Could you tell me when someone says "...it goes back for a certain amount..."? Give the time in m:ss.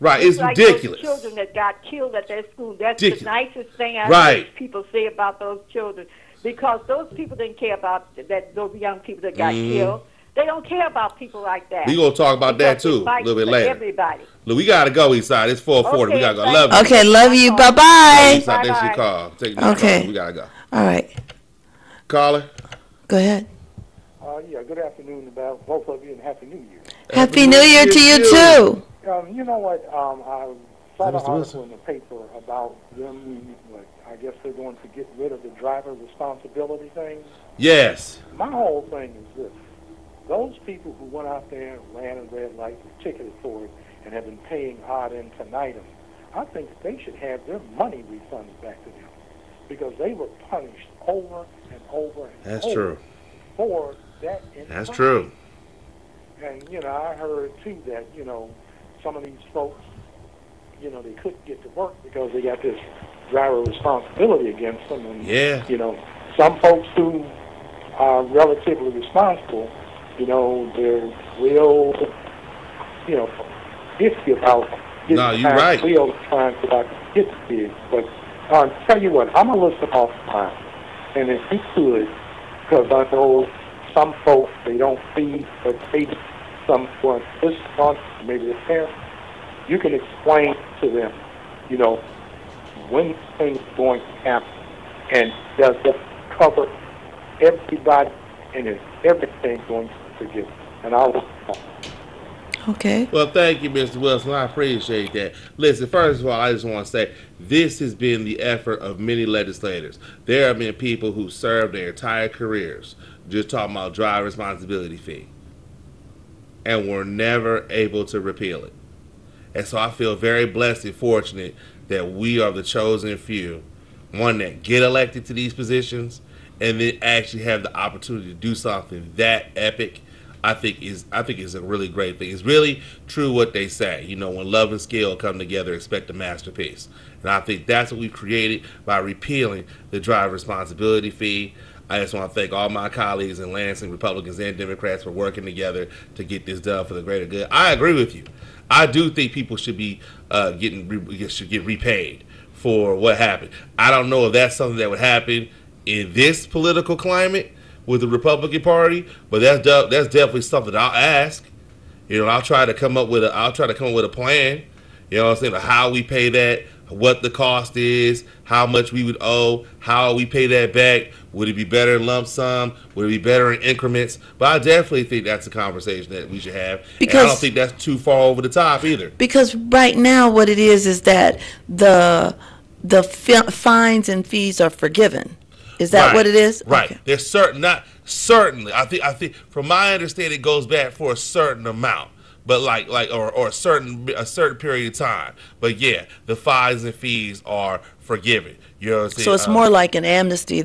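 3:10.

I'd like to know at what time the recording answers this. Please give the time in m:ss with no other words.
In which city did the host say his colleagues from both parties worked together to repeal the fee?
2:23.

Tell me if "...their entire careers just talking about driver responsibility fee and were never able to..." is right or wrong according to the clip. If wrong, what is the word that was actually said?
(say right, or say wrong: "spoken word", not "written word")
right.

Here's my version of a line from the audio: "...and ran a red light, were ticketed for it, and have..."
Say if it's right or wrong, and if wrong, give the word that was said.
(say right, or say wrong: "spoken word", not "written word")
right.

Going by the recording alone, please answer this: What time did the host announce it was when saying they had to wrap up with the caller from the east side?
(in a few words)
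4:40.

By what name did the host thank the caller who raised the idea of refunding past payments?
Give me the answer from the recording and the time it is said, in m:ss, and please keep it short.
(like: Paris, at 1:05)
Mr. Wilson, at 1:43.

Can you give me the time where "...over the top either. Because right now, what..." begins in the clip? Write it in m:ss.
2:58.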